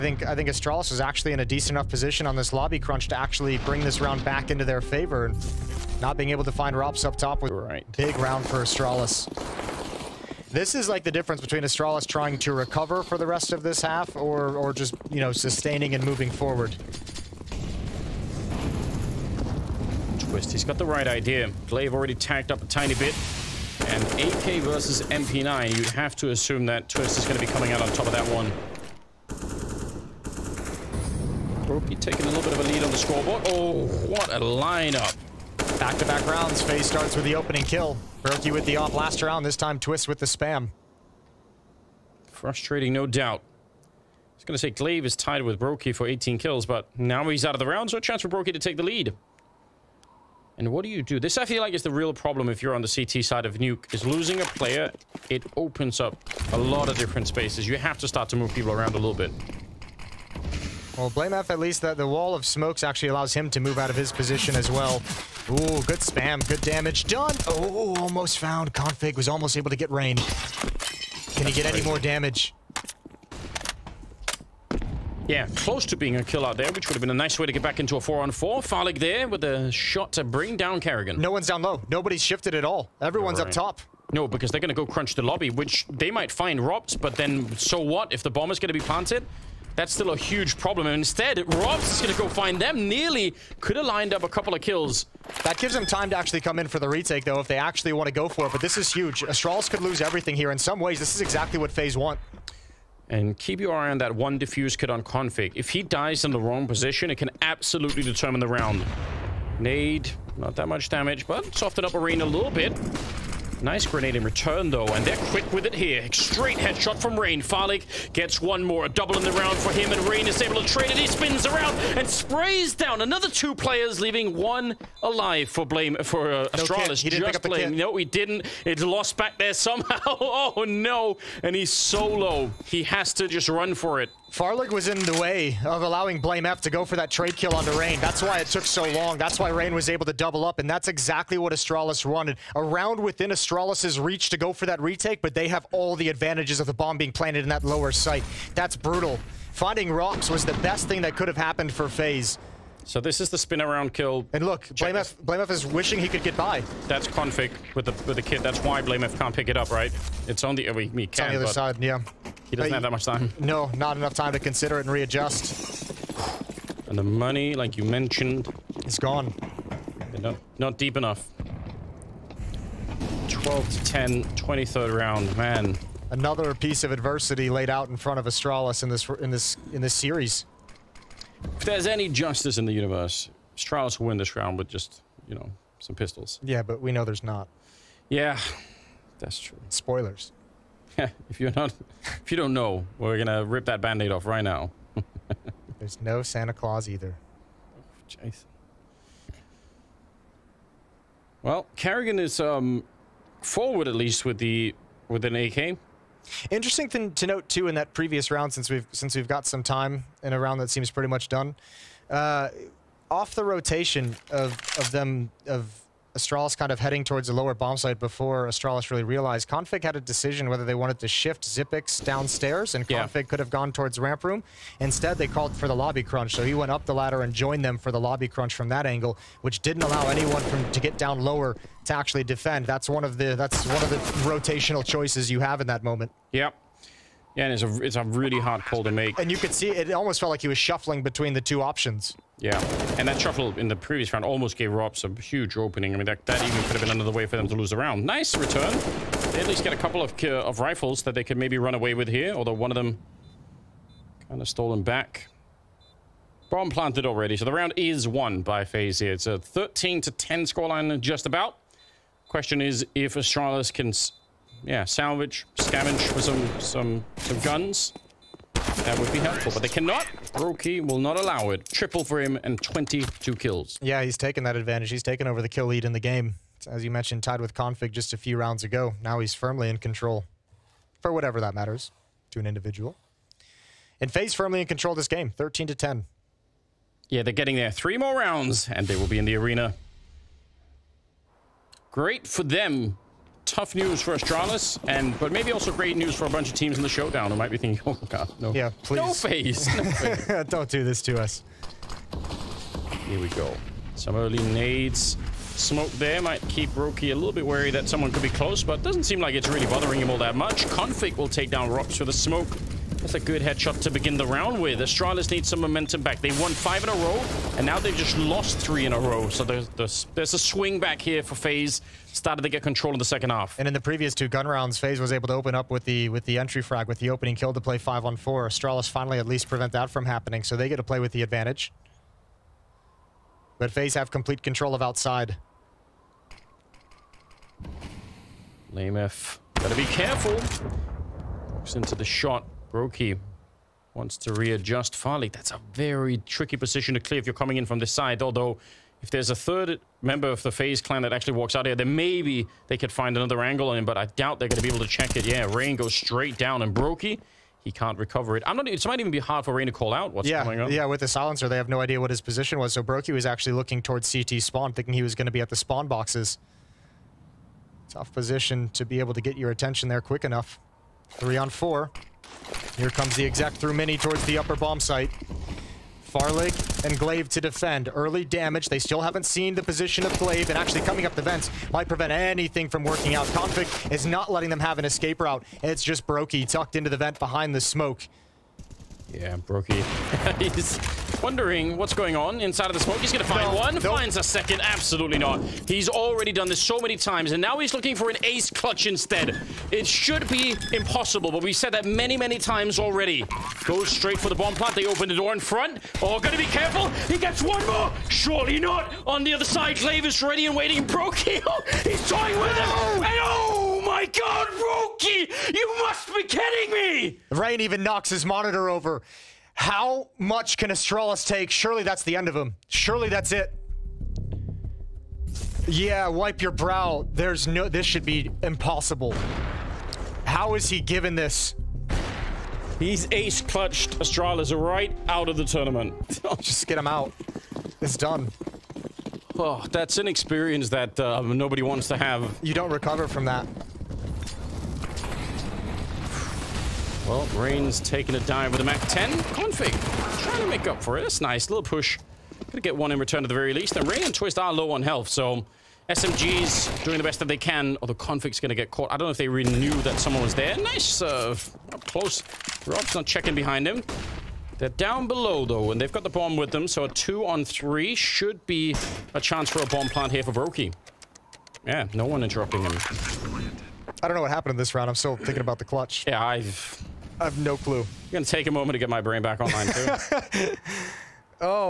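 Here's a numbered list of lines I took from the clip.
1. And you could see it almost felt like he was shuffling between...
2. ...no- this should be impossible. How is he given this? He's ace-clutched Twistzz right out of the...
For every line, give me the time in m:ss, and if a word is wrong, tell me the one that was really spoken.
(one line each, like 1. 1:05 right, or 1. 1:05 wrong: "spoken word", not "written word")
1. 3:59 right
2. 7:07 wrong: "Astralis", not "Twistzz".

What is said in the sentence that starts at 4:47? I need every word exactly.
Three more rounds, and they will be in the arena.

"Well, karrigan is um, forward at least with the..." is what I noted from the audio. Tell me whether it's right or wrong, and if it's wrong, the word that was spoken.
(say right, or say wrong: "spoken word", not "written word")
right.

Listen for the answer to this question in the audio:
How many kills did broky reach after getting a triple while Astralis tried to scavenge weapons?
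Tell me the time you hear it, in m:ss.
4:32.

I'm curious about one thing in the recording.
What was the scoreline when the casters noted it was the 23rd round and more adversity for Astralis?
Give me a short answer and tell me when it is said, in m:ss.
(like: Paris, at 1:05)
12 to 10, at 2:53.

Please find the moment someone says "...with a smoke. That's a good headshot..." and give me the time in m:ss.
5:11.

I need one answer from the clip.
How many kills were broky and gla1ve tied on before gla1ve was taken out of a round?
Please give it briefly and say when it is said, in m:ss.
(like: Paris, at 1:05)
18, at 0:46.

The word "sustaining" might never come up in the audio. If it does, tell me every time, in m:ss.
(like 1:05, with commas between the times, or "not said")
0:15.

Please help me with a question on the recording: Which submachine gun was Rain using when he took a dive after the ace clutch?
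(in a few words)
MAC-10.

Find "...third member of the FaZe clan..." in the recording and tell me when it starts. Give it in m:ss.
5:49.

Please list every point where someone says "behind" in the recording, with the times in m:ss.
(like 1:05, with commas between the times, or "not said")
6:27, 7:43.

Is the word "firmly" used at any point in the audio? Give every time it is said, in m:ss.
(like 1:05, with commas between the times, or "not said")
4:39, 4:44.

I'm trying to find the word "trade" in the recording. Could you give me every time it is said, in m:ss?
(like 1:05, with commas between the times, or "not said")
2:00, 2:17.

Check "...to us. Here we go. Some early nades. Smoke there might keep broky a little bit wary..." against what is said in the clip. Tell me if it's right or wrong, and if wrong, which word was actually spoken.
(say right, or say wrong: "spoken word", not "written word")
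right.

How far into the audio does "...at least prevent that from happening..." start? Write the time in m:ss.
5:29.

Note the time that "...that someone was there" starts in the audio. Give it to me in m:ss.
7:39.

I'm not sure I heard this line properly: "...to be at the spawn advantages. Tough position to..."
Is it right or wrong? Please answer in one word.
wrong.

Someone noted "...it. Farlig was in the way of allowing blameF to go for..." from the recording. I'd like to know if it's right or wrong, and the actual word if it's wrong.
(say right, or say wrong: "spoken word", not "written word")
right.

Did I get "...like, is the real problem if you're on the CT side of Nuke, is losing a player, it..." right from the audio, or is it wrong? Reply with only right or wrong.
right.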